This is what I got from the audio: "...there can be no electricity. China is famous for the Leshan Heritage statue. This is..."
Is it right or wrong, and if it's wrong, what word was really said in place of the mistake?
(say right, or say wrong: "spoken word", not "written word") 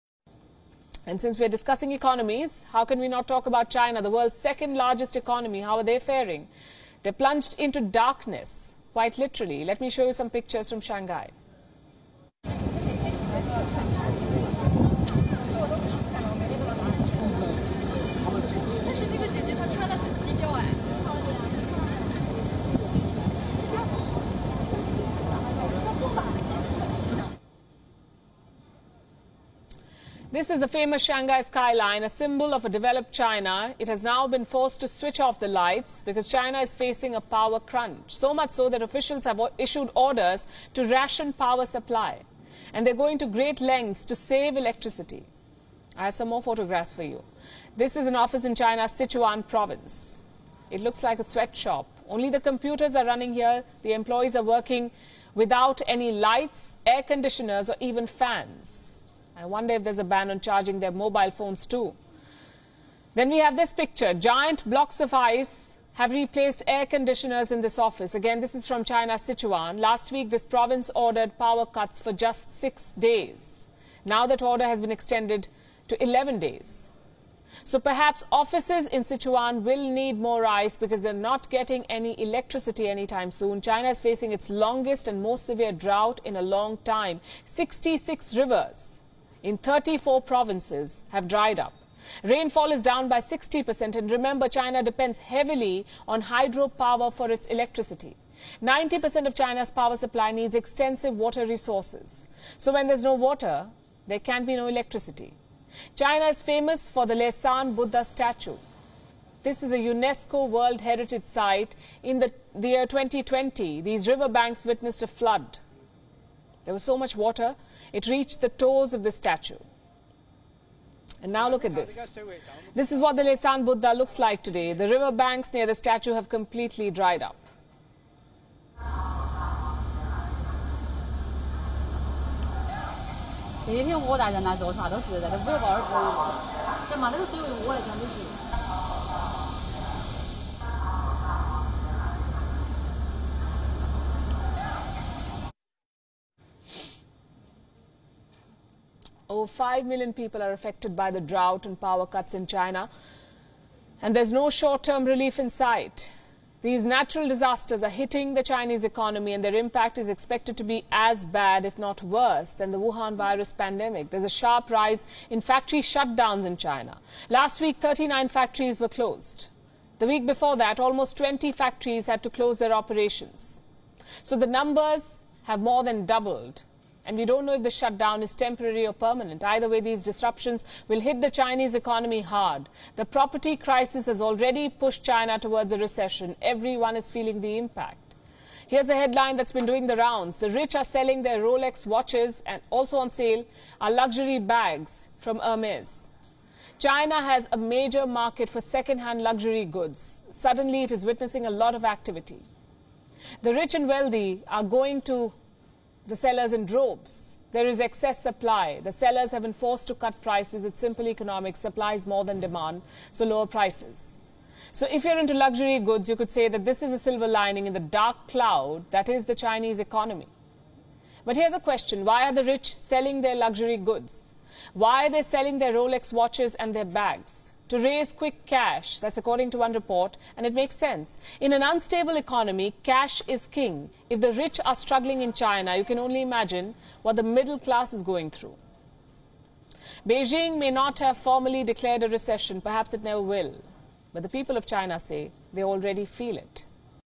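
wrong: "Buddha", not "Heritage".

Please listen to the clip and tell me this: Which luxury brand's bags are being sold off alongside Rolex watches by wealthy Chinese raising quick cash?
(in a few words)
Hermes.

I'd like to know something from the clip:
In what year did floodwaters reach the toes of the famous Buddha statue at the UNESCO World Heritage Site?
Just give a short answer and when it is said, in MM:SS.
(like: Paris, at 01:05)
2020, at 01:52.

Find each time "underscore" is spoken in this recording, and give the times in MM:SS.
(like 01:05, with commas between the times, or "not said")
not said.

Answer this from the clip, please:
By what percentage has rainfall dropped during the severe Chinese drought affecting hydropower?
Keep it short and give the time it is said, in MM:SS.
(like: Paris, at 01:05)
60%, at 01:33.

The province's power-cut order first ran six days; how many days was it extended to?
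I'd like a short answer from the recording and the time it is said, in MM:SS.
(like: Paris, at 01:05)
11 days, at 01:16.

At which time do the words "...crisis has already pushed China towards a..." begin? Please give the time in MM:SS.
03:03.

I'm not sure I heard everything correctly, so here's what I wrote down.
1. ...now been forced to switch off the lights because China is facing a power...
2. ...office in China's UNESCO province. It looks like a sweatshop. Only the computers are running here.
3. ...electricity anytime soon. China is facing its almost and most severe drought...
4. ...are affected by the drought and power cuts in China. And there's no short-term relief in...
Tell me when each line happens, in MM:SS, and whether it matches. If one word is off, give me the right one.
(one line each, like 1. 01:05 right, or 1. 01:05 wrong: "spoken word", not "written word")
1. 00:34 right
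2. 00:48 wrong: "Sichuan", not "UNESCO"
3. 01:22 wrong: "longest", not "almost"
4. 02:30 right.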